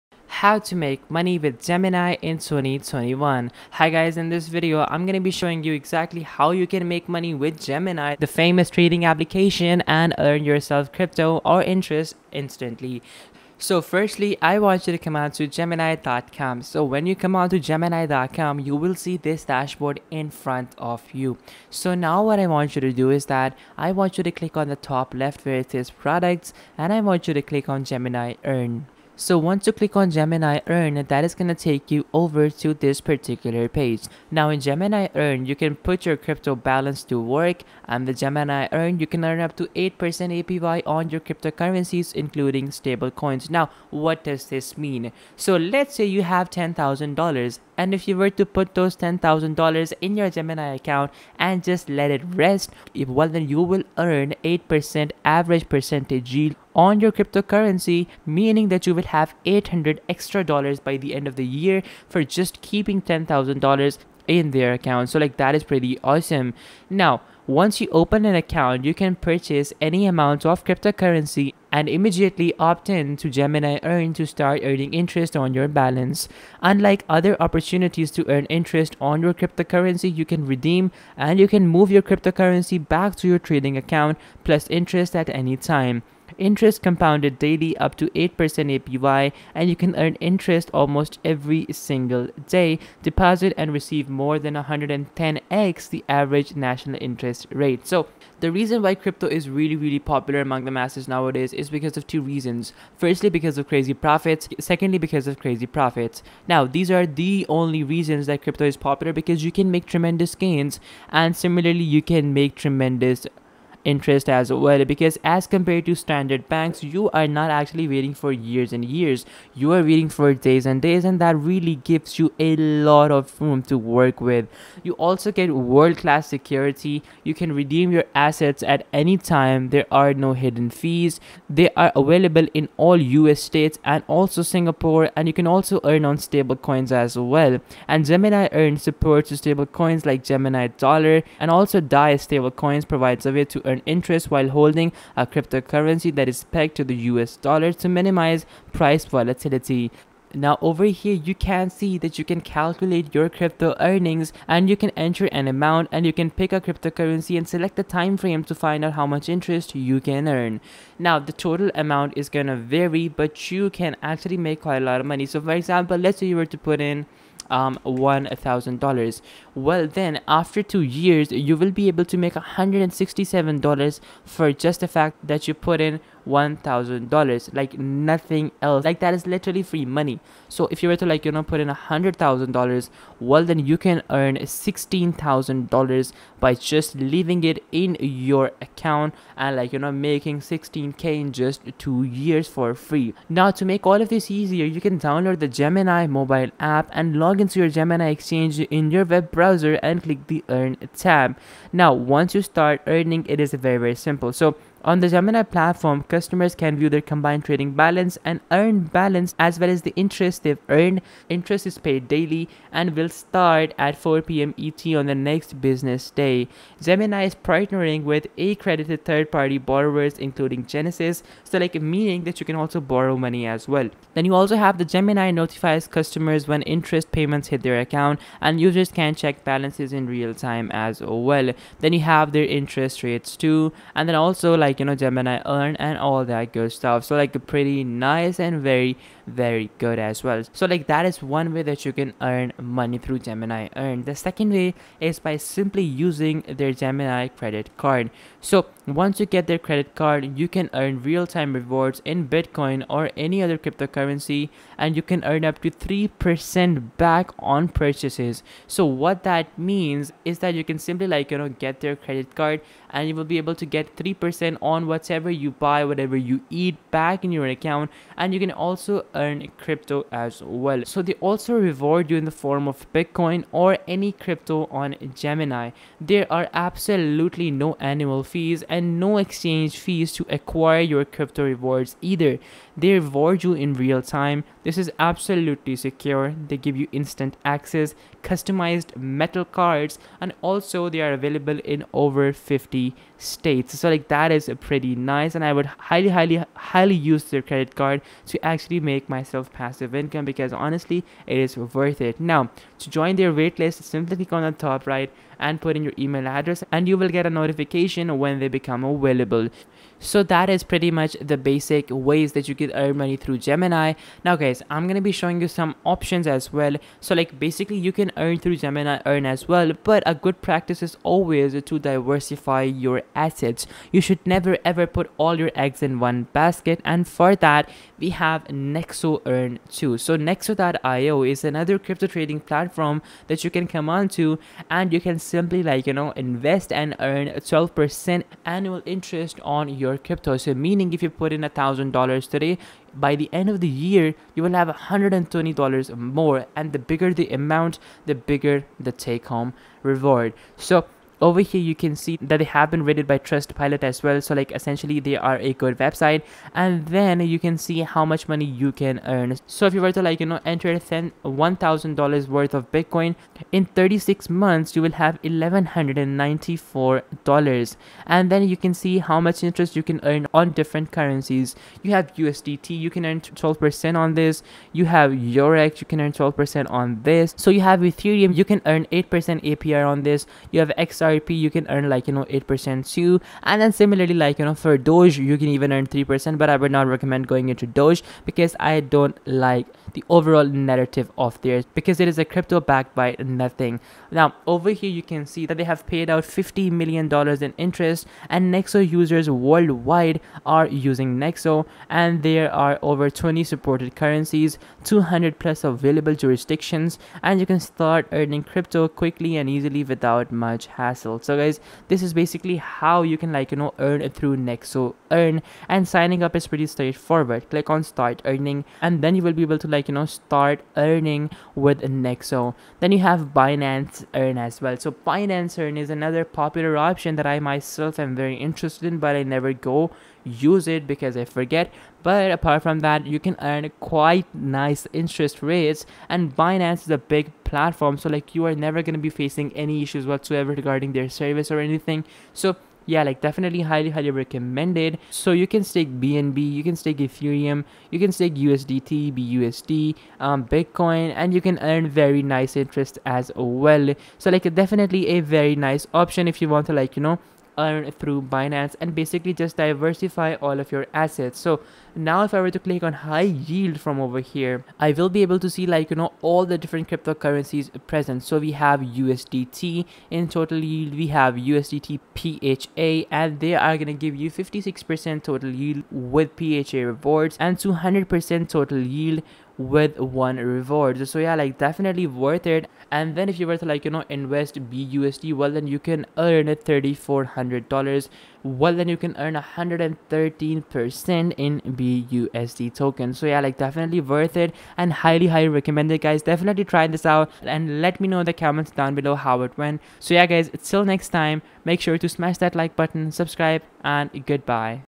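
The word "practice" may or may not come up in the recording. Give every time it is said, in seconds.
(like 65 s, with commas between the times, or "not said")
320 s.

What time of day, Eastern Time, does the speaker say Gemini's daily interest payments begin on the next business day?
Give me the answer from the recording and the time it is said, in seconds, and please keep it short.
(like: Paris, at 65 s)
4 p.m., at 213 s.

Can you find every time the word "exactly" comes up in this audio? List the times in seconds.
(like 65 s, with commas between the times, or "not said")
5 s.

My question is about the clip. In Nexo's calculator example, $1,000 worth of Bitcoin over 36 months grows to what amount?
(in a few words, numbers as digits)
$1,194.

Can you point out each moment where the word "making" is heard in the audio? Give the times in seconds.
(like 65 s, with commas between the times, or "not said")
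189 s.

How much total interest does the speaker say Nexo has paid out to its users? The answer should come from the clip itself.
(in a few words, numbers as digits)
$50 million.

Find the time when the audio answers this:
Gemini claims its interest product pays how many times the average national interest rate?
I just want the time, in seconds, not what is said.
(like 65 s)
94 s.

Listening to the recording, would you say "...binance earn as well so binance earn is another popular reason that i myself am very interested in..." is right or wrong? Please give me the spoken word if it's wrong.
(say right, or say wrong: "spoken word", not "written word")
wrong: "option", not "reason".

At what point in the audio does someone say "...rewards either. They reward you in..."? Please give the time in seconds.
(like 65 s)
281 s.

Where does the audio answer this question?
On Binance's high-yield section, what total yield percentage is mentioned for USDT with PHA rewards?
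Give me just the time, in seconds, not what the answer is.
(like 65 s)
474 s.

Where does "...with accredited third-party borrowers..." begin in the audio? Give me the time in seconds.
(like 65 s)
218 s.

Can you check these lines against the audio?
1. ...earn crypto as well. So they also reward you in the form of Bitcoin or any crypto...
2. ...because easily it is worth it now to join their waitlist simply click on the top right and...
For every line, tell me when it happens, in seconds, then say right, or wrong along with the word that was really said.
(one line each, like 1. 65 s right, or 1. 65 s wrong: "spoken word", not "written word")
1. 269 s right
2. 300 s wrong: "honestly", not "easily".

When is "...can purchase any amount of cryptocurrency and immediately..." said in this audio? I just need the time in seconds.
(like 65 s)
68 s.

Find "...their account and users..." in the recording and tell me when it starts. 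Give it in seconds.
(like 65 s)
227 s.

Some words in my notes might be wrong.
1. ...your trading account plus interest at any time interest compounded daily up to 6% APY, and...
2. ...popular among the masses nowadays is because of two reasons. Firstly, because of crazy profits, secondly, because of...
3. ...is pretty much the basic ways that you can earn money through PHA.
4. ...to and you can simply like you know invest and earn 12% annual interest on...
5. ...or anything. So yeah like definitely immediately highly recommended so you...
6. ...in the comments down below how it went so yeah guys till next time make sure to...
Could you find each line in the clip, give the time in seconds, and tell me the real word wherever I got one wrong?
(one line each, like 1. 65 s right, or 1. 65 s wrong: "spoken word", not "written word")
1. 83 s wrong: "8", not "6"
2. 99 s right
3. 310 s wrong: "Gemini", not "PHA"
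4. 334 s right
5. 441 s wrong: "highly", not "immediately"
6. 498 s right.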